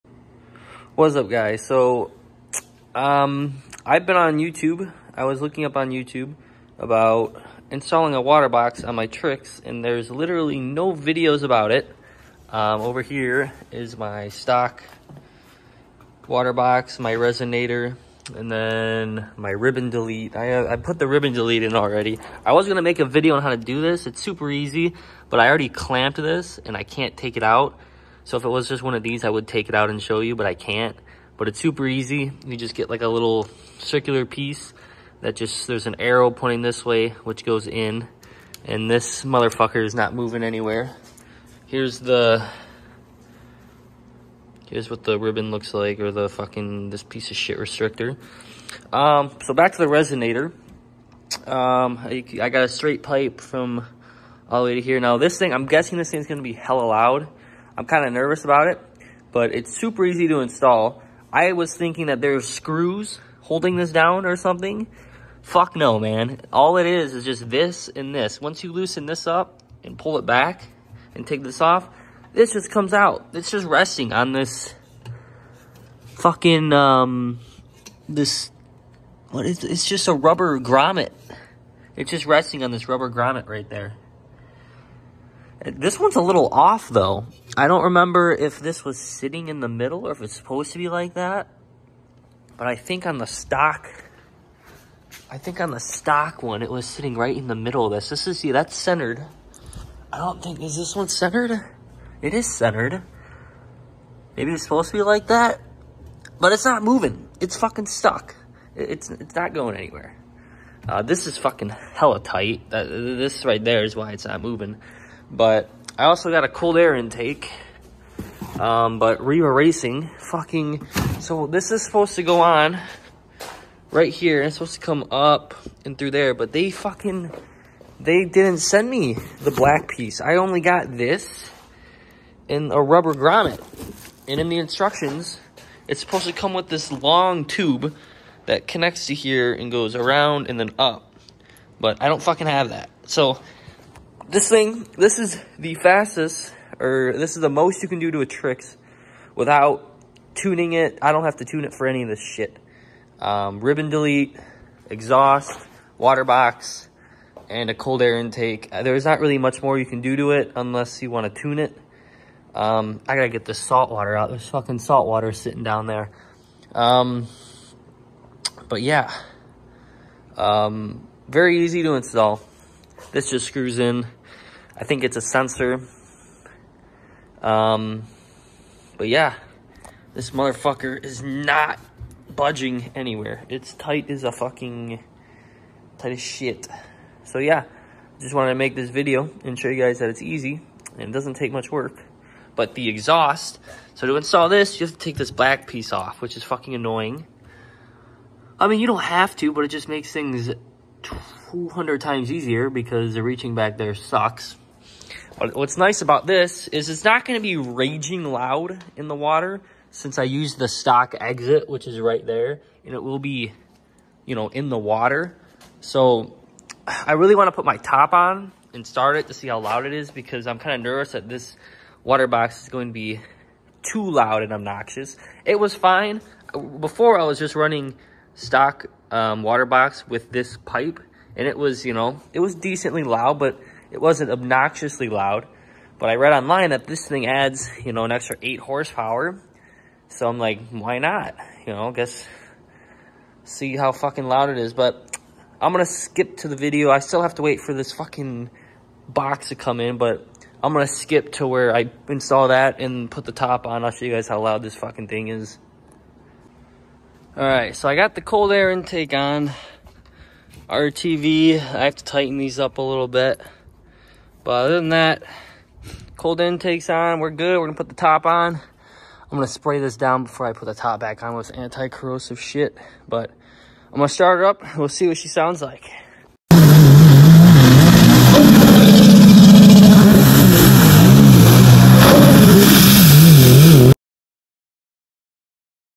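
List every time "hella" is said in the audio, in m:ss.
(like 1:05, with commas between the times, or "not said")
0:56, 1:51.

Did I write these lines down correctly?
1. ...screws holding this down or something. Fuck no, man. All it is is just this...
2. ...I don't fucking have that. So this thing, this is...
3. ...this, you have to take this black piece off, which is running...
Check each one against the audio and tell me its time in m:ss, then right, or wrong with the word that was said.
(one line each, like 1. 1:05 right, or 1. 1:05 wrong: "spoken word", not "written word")
1. 1:02 right
2. 2:22 right
3. 3:14 wrong: "fucking", not "running".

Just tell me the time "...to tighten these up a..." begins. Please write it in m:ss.
4:21.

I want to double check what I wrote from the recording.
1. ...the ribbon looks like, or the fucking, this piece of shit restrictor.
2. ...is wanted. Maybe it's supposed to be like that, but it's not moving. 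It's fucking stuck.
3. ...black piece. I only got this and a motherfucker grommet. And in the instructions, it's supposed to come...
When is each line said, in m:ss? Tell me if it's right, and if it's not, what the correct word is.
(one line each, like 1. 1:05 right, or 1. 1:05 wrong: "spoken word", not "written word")
1. 0:45 right
2. 1:42 wrong: "centered", not "wanted"
3. 2:09 wrong: "rubber", not "motherfucker".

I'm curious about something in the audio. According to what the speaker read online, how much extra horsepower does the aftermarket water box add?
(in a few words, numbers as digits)
8.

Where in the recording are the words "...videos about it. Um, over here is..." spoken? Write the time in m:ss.
0:10.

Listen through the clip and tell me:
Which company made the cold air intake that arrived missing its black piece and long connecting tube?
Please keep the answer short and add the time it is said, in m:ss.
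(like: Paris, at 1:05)
Riva Racing, at 1:59.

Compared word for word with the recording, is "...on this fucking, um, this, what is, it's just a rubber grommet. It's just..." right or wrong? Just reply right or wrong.
right.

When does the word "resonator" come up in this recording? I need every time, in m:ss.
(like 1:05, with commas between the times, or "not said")
0:17, 0:49.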